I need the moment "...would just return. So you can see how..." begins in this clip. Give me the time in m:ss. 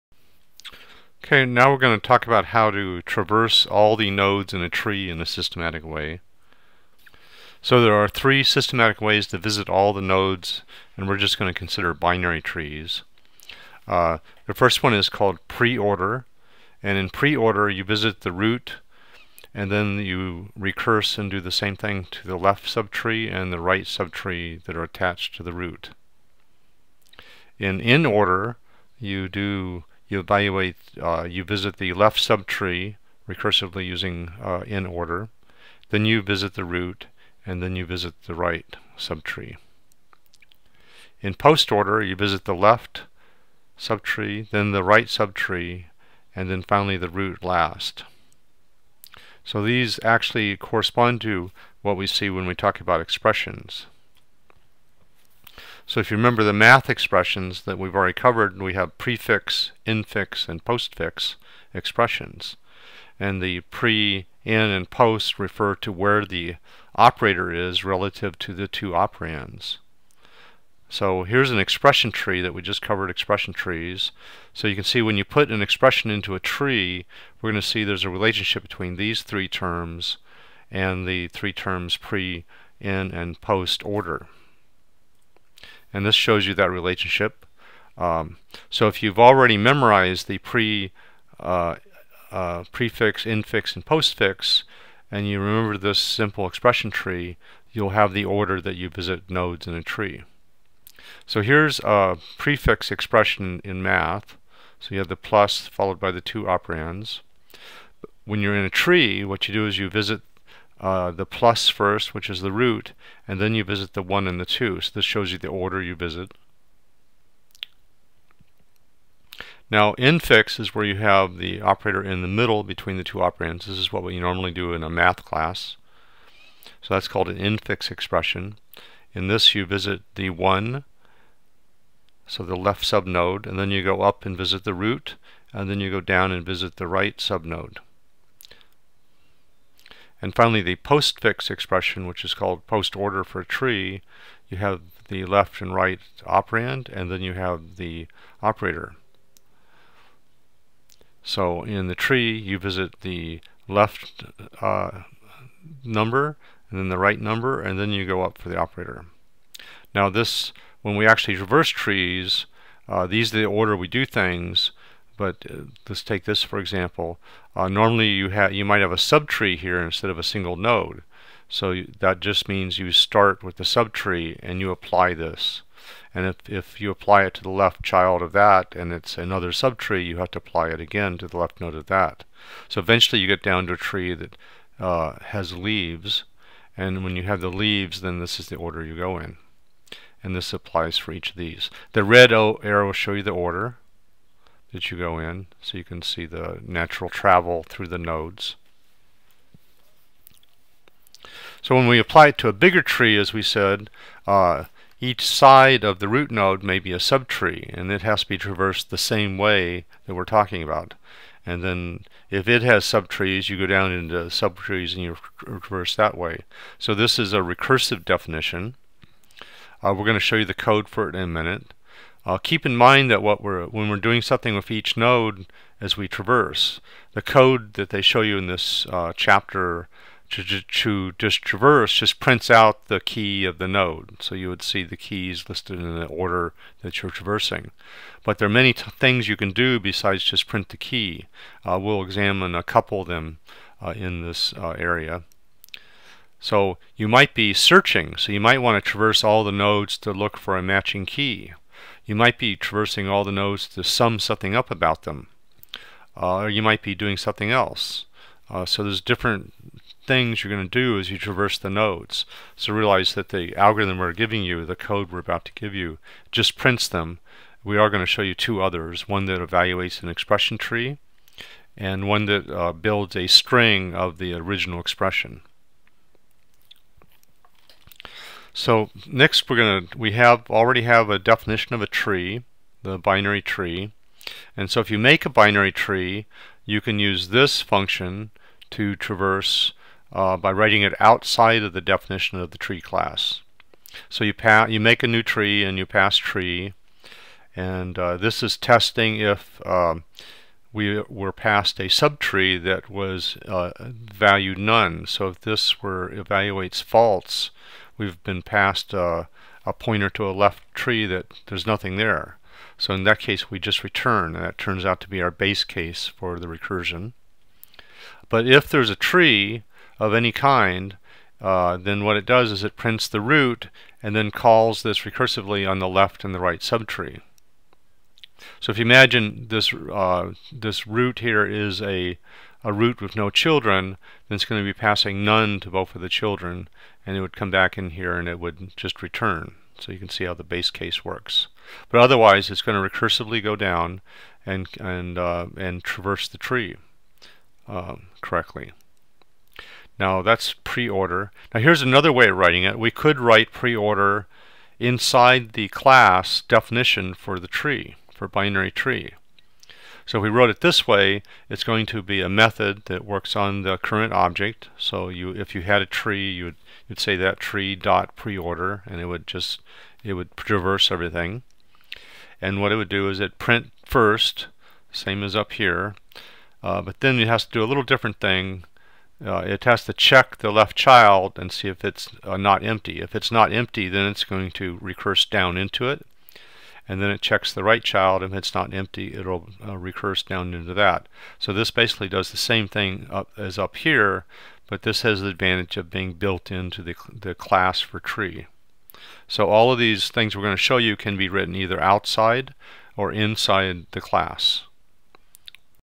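5:38.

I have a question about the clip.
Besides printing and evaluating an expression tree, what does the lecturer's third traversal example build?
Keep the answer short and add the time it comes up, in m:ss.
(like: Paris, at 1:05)
a string, at 4:32.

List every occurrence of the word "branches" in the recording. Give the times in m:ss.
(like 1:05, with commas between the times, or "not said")
not said.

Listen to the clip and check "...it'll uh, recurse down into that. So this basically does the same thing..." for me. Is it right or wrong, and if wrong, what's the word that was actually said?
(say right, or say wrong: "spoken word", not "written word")
right.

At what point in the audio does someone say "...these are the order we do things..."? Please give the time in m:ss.
2:43.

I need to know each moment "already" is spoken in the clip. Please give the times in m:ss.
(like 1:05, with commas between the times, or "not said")
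0:57, 1:29, 4:40.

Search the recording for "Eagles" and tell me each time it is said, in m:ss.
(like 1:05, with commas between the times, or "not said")
not said.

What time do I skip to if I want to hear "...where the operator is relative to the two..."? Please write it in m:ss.
1:05.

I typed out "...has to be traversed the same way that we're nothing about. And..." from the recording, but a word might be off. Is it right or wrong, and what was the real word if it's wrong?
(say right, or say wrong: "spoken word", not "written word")
wrong: "talking", not "nothing".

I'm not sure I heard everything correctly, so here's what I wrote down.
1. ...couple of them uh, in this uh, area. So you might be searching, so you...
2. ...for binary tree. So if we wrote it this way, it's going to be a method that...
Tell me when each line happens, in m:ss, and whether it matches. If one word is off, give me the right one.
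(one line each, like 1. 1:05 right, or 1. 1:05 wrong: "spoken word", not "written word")
1. 4:02 right
2. 5:58 right.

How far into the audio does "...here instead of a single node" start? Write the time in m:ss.
2:49.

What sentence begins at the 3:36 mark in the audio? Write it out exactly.
So this is a recursive definition.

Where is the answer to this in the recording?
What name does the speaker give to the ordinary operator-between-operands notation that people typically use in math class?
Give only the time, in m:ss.
2:07.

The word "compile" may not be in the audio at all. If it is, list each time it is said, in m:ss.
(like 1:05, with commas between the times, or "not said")
not said.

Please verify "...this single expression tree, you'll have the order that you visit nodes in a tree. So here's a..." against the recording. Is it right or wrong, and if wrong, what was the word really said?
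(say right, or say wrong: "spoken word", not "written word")
wrong: "simple", not "single".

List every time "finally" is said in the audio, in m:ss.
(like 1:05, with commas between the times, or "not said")
0:46, 2:20.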